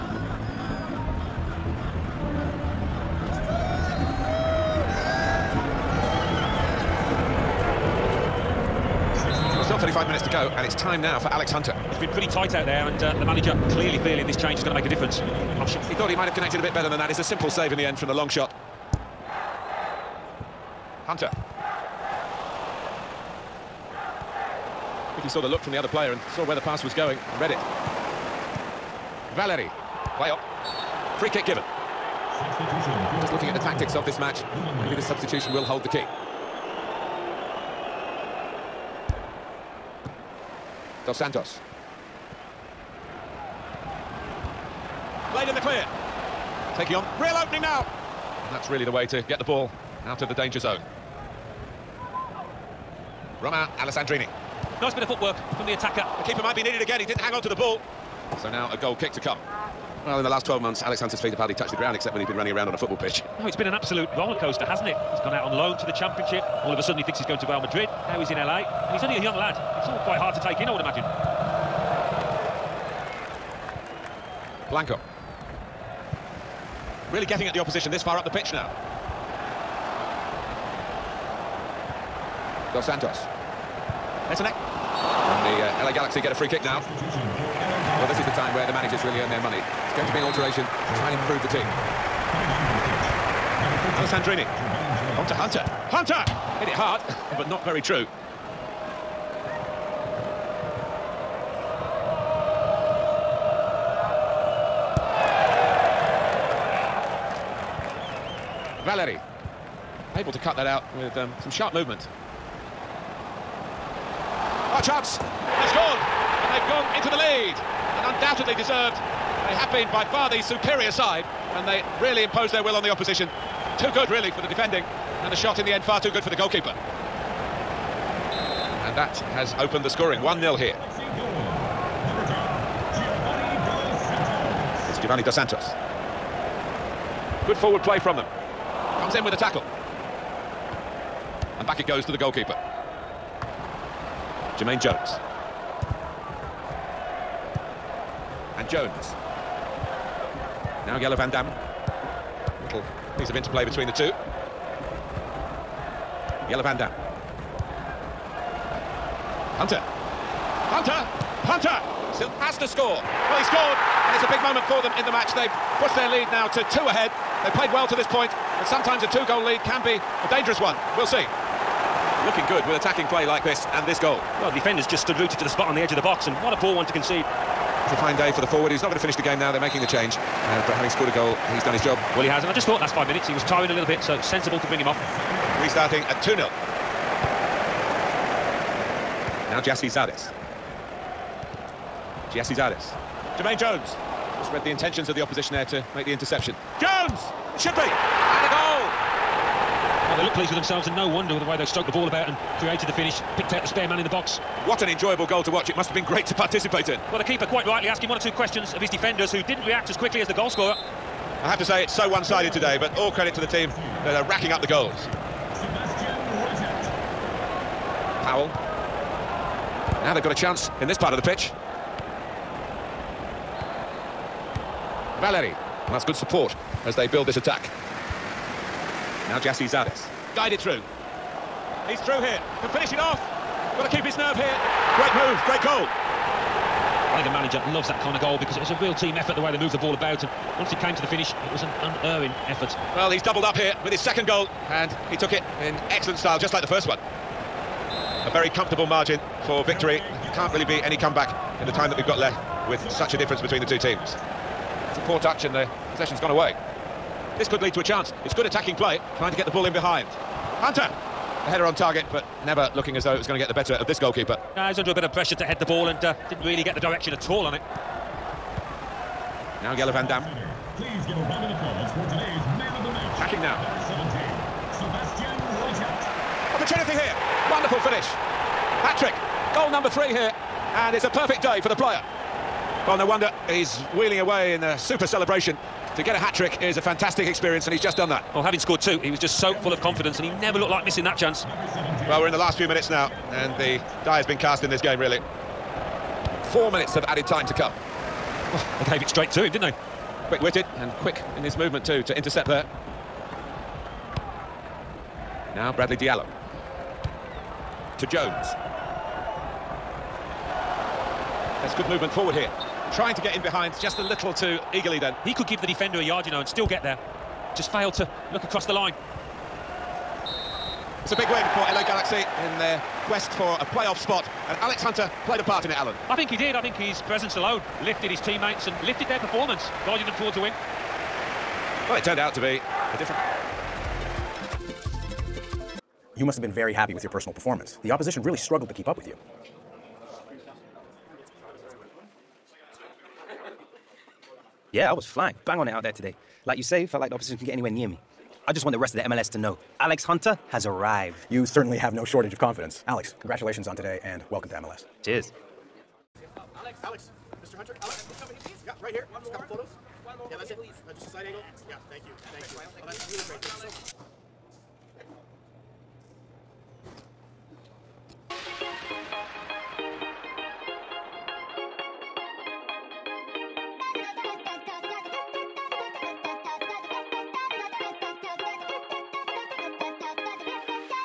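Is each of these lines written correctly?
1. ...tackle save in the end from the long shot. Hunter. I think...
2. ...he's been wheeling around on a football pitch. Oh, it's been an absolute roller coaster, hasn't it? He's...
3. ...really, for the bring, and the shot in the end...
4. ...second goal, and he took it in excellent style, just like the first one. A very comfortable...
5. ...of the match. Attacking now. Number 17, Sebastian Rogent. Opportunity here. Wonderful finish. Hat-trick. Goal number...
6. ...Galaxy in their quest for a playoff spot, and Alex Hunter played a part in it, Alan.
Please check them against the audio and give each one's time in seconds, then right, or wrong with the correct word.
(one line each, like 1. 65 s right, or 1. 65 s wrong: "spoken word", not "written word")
1. 17 s wrong: "simple", not "tackle"
2. 62 s wrong: "running", not "wheeling"
3. 124 s wrong: "defending", not "bring"
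4. 243 s right
5. 272 s right
6. 321 s right.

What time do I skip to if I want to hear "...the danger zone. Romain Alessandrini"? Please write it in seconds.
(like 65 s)
50 s.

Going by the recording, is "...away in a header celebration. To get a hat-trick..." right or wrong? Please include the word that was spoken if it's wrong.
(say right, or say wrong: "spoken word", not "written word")
wrong: "super", not "header".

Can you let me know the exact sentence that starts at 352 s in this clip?
Alex, congratulations on today and welcome to MLS.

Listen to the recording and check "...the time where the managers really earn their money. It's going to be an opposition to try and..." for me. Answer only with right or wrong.
wrong.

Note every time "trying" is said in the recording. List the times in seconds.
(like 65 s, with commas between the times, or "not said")
259 s, 312 s.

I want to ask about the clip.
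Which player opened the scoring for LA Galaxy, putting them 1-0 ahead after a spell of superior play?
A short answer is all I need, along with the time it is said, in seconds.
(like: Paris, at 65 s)
Giovanni Dos Santos, at 135 s.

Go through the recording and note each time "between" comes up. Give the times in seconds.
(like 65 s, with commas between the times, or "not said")
153 s, 253 s.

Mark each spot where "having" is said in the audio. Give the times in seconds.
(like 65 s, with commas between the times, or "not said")
180 s, 288 s.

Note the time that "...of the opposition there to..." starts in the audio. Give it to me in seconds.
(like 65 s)
195 s.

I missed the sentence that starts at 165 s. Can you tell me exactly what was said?
They've pushed their lead now to two ahead.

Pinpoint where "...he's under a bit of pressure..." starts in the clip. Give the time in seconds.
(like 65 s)
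264 s.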